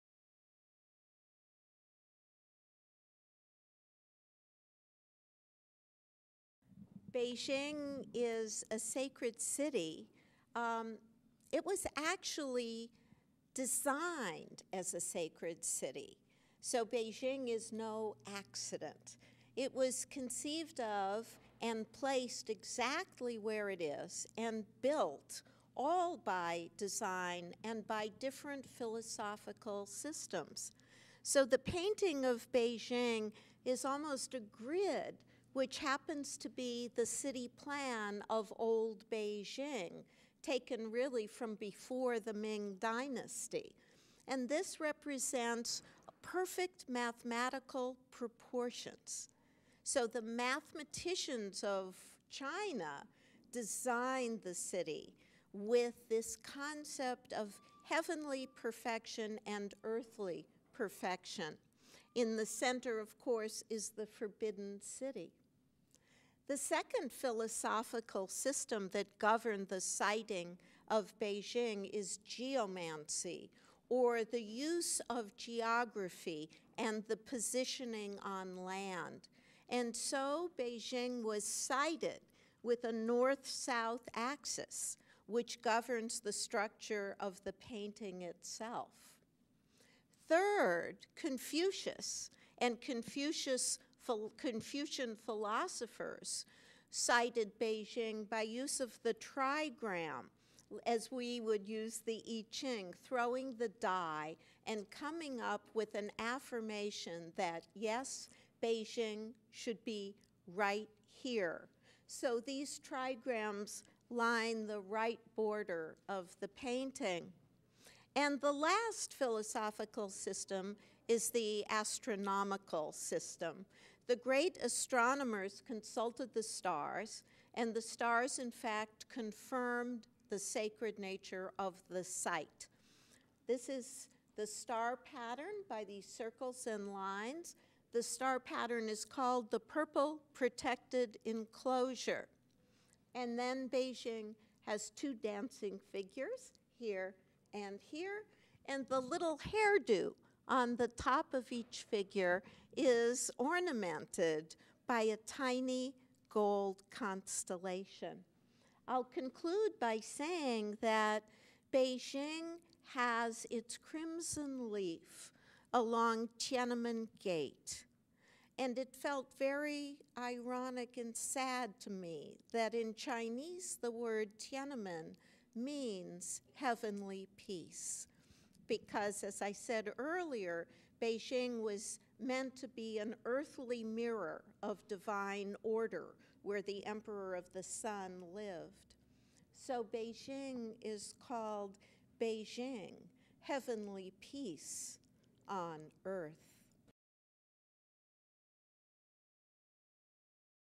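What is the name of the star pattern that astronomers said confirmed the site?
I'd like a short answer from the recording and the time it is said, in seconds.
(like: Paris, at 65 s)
Purple Protected Enclosure, at 139 s.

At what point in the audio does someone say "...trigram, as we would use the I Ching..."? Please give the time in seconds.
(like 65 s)
99 s.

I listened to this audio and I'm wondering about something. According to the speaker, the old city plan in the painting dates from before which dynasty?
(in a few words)
Ming Dynasty.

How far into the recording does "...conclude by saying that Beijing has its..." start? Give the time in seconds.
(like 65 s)
159 s.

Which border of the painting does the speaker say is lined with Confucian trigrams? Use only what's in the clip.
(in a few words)
Right border.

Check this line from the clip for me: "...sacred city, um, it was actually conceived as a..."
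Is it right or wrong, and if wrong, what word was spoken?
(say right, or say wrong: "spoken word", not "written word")
wrong: "designed", not "conceived".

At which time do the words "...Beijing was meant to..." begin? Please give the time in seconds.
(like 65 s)
181 s.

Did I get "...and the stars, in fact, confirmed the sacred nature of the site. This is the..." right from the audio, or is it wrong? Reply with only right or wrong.
right.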